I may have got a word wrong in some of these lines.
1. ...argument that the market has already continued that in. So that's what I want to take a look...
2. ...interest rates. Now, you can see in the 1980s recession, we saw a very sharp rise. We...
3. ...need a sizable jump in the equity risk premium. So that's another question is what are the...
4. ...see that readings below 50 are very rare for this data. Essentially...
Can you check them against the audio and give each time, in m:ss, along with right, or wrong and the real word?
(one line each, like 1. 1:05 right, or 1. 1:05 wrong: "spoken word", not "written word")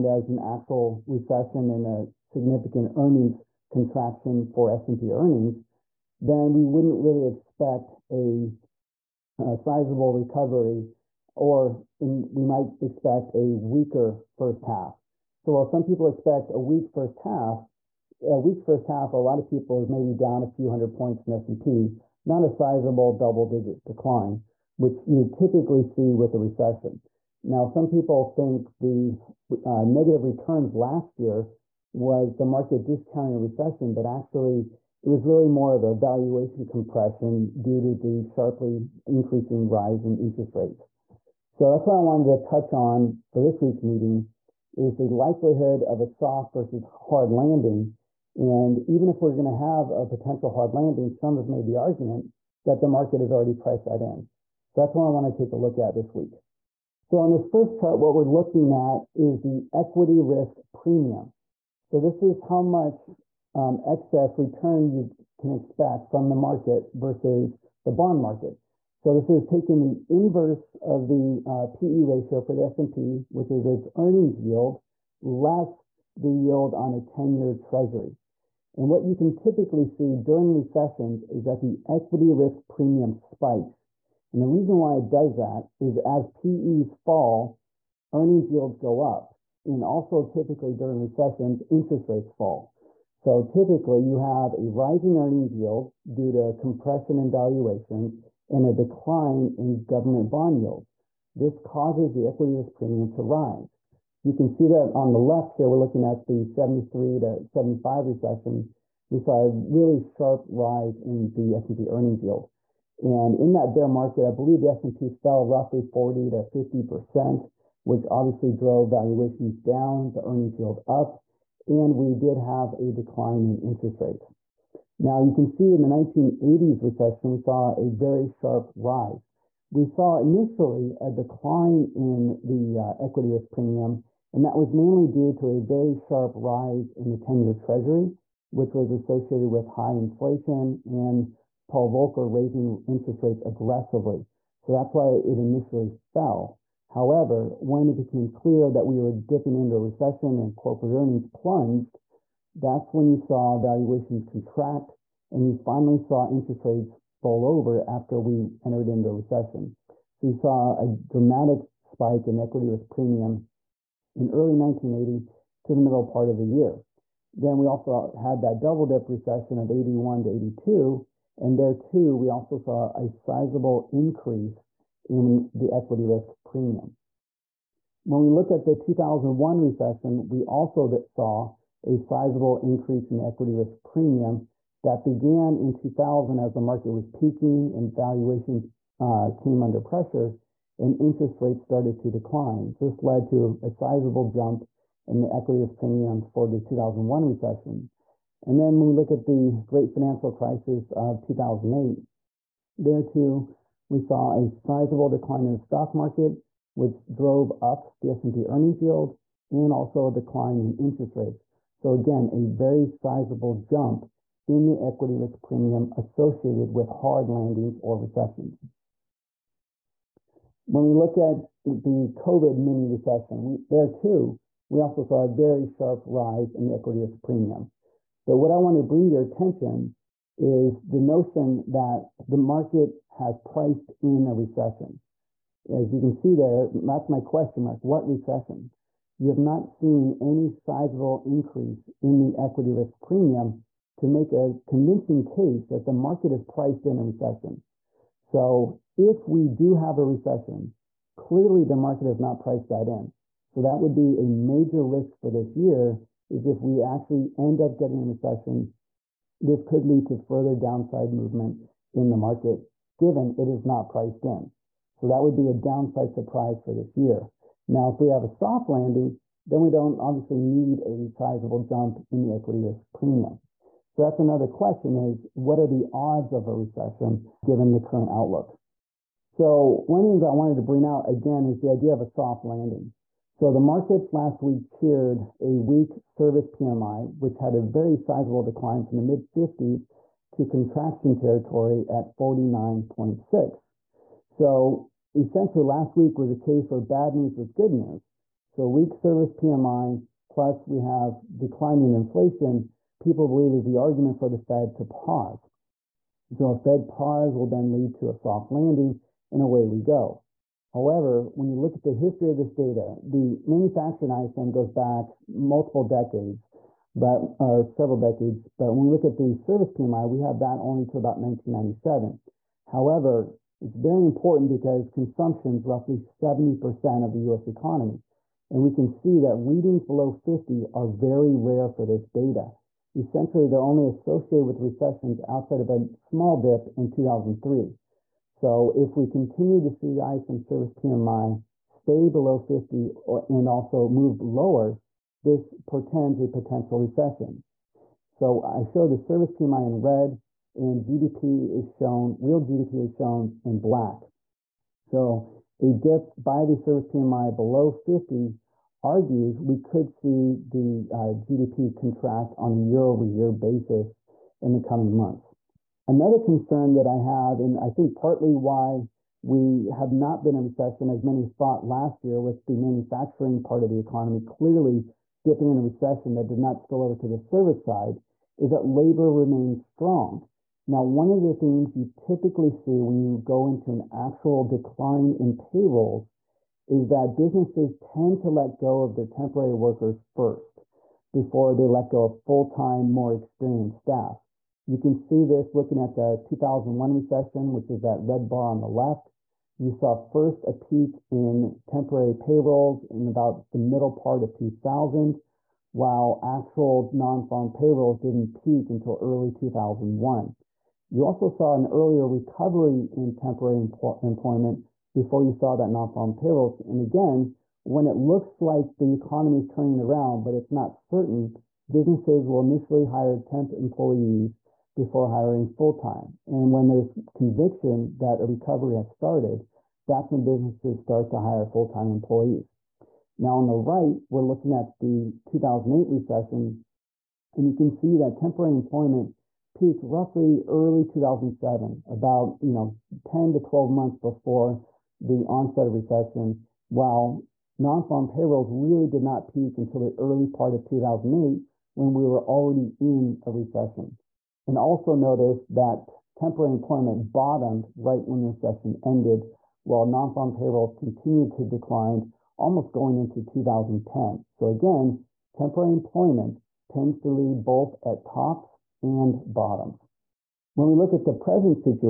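1. 0:51 wrong: "priced", not "continued"
2. 2:03 right
3. 4:30 right
4. 5:28 right.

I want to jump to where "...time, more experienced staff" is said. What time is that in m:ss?
6:32.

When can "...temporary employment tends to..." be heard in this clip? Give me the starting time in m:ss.
7:45.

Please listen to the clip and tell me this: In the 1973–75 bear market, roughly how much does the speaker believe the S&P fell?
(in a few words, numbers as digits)
40 to 50%.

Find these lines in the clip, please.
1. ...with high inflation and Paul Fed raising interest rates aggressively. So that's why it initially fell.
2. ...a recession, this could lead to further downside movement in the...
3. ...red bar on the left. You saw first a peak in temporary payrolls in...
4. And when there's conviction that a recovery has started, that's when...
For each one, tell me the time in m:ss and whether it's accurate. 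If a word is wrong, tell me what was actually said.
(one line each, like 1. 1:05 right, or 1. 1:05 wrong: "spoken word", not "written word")
1. 2:19 wrong: "Volcker", not "Fed"
2. 4:18 right
3. 6:38 right
4. 7:06 right.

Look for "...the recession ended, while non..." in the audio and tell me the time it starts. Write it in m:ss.
7:38.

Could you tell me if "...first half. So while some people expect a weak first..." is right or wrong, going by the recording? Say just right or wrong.
right.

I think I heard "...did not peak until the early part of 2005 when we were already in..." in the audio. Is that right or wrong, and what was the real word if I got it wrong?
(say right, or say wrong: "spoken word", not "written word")
wrong: "2008", not "2005".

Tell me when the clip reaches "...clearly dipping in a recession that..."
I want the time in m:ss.
6:14.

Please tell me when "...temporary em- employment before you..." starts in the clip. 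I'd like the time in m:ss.
6:53.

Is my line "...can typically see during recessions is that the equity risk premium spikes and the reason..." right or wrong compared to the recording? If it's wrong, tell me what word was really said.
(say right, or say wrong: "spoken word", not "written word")
right.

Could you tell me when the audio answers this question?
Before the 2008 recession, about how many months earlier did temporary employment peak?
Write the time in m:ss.
7:23.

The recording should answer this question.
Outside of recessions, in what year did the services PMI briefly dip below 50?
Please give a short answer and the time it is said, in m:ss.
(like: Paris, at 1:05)
2003, at 5:36.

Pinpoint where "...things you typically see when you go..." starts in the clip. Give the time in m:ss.
6:21.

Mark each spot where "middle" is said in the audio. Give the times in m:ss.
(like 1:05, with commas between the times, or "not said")
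2:45, 6:43.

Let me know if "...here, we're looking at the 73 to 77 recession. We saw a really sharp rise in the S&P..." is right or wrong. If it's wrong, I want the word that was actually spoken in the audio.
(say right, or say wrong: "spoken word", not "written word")
wrong: "75", not "77".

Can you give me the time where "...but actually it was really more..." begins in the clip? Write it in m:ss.
0:33.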